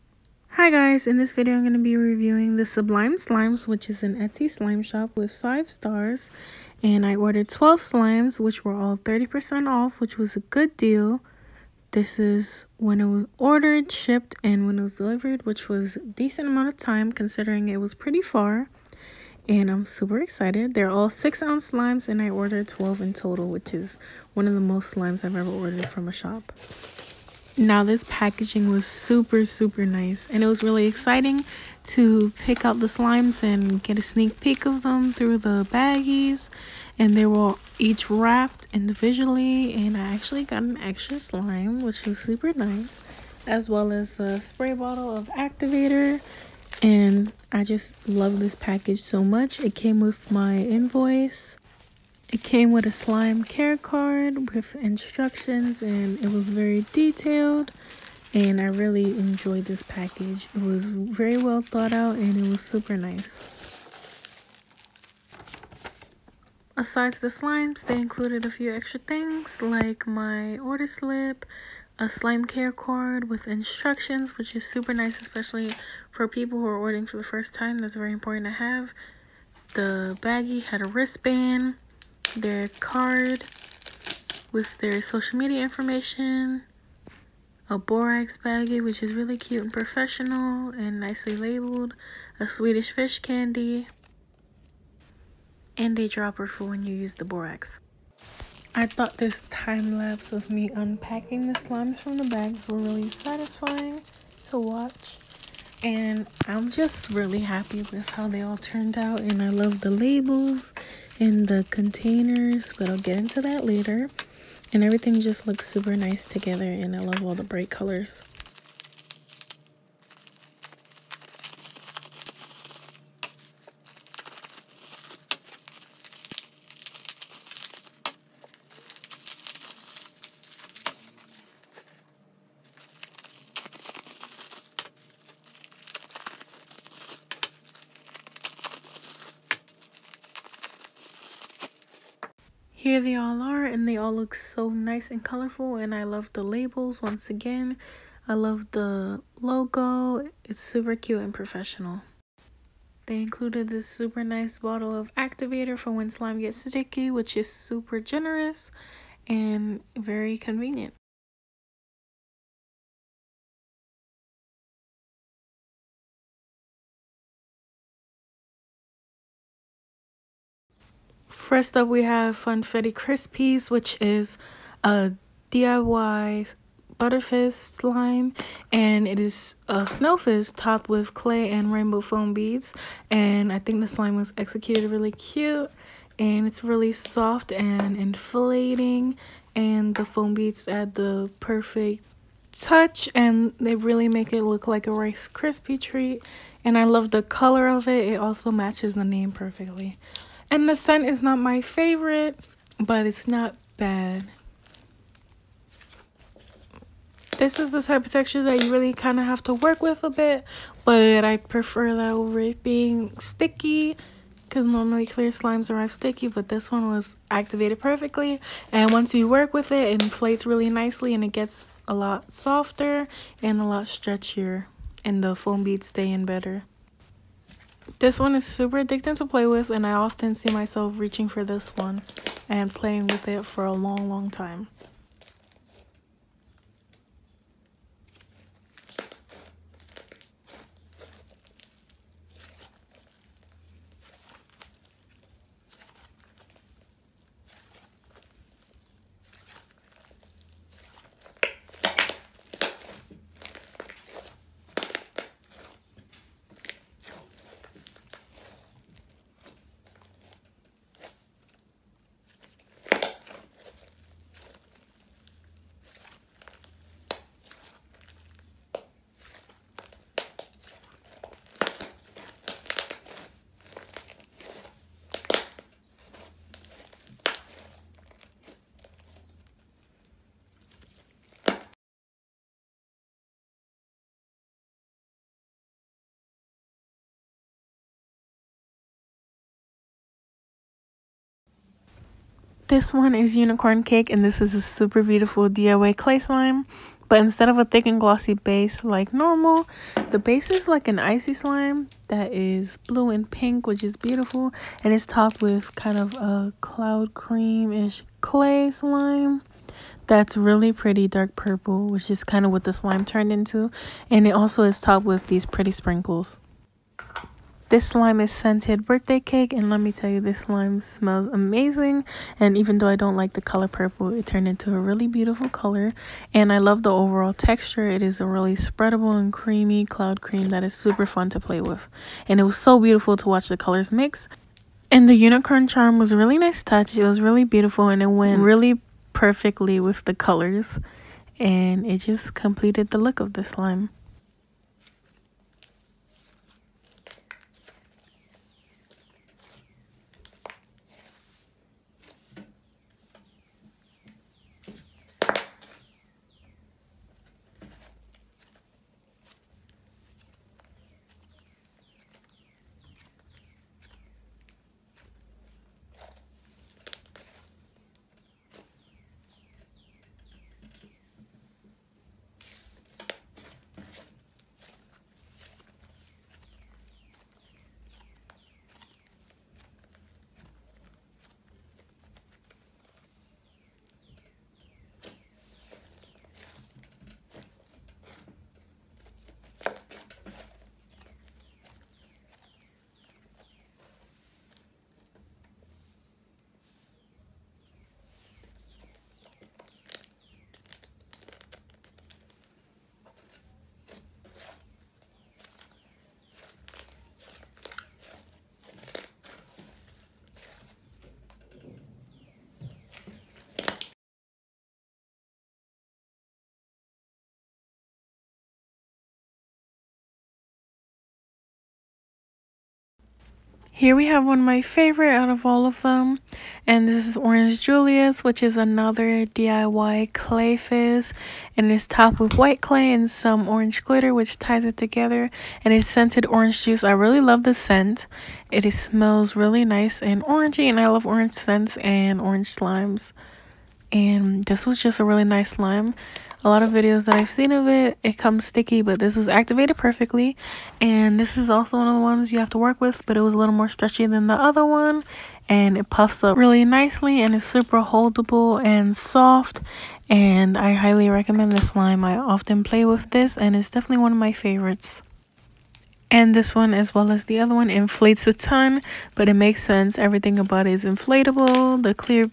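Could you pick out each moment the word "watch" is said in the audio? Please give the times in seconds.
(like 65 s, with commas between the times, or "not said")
104 s, 333 s.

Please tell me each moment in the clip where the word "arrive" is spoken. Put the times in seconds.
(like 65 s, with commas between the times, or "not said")
215 s.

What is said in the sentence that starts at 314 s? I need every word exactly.
And it also is topped with these pretty sprinkles.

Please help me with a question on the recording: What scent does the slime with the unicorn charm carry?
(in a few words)
Birthday cake.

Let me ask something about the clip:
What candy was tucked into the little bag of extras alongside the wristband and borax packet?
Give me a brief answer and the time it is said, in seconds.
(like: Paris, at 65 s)
Swedish fish, at 92 s.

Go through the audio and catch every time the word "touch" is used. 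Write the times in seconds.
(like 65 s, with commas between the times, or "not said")
192 s, 336 s.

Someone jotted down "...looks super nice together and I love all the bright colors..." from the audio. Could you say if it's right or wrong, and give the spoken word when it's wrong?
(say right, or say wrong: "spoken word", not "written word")
right.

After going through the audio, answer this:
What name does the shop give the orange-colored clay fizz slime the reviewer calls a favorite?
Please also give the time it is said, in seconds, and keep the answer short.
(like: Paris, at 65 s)
Orange Julius, at 427 s.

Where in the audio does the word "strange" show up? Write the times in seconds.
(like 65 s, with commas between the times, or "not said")
not said.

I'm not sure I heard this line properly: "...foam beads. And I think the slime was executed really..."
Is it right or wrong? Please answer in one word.
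right.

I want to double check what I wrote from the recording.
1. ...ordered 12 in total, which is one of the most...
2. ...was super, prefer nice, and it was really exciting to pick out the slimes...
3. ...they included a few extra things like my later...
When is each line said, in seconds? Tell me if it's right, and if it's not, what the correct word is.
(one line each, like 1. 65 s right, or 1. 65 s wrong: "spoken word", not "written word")
1. 22 s right
2. 28 s wrong: "super", not "prefer"
3. 67 s wrong: "order", not "later".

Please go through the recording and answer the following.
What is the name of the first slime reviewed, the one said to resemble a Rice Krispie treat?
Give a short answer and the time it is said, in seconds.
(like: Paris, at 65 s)
Funfetti Crispies, at 172 s.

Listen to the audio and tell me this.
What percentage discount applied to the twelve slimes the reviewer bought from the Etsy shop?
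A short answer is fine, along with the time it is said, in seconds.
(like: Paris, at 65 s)
30%, at 8 s.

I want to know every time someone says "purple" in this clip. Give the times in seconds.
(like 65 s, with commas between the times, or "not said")
311 s, 323 s.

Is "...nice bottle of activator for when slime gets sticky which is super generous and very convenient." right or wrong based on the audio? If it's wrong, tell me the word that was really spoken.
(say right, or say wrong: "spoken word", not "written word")
right.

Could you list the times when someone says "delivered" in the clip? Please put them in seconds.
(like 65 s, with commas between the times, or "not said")
14 s.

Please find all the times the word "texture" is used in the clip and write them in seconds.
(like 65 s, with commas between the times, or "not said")
208 s, 327 s.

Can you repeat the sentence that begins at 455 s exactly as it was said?
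And it puffs up really nicely and it's super holdable and soft.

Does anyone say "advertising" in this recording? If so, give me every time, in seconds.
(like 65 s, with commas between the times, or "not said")
not said.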